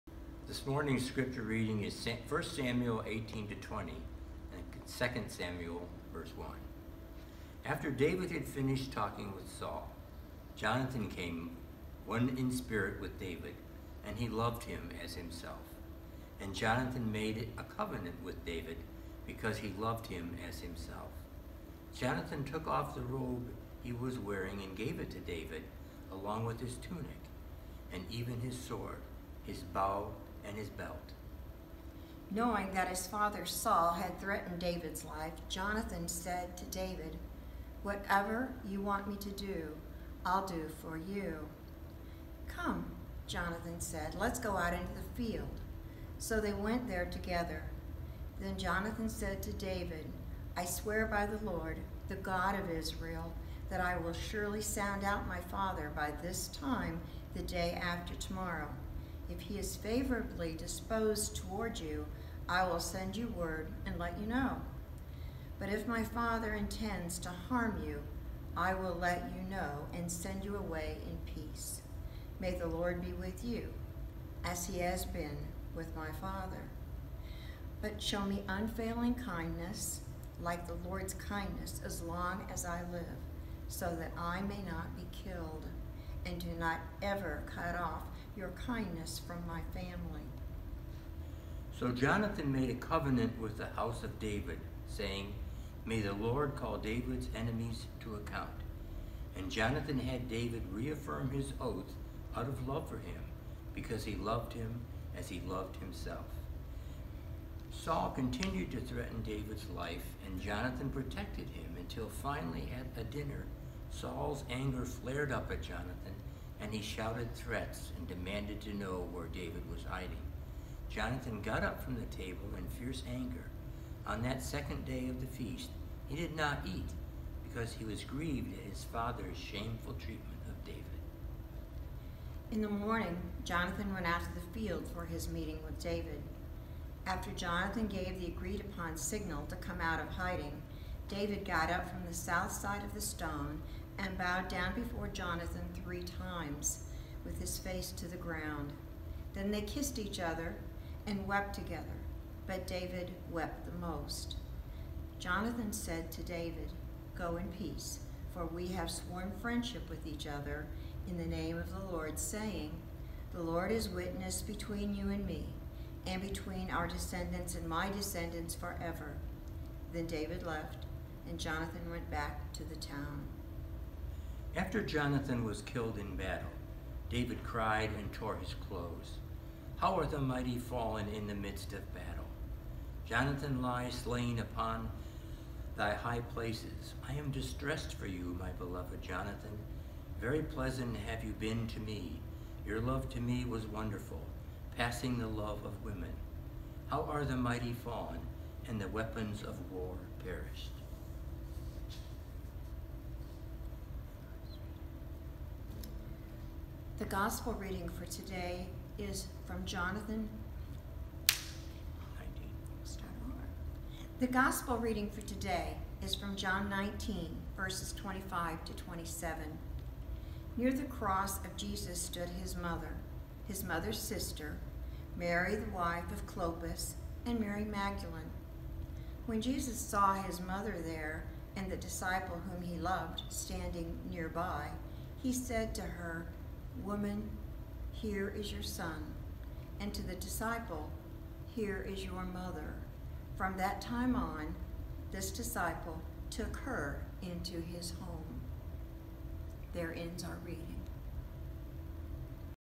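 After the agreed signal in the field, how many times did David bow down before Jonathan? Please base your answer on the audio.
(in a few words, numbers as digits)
3.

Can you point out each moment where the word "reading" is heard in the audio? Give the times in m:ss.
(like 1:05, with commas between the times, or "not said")
0:01, 3:27, 3:34, 4:10.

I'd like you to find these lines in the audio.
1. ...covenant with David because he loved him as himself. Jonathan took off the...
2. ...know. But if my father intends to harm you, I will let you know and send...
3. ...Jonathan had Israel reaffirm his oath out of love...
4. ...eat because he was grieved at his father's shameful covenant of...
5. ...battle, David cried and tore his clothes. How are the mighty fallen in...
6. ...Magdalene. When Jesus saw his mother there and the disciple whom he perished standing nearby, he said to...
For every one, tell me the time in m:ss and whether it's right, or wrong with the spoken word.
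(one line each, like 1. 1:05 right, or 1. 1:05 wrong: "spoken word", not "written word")
1. 0:17 right
2. 1:04 right
3. 1:39 wrong: "David", not "Israel"
4. 2:06 wrong: "treatment", not "covenant"
5. 2:56 right
6. 3:47 wrong: "loved", not "perished".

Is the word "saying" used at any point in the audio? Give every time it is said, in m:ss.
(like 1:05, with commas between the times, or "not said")
1:34, 2:42.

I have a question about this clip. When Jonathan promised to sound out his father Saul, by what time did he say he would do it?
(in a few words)
the day after tomorrow.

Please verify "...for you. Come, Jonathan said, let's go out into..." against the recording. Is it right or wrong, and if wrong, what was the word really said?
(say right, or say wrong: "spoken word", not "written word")
right.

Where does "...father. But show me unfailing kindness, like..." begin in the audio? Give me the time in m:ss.
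1:16.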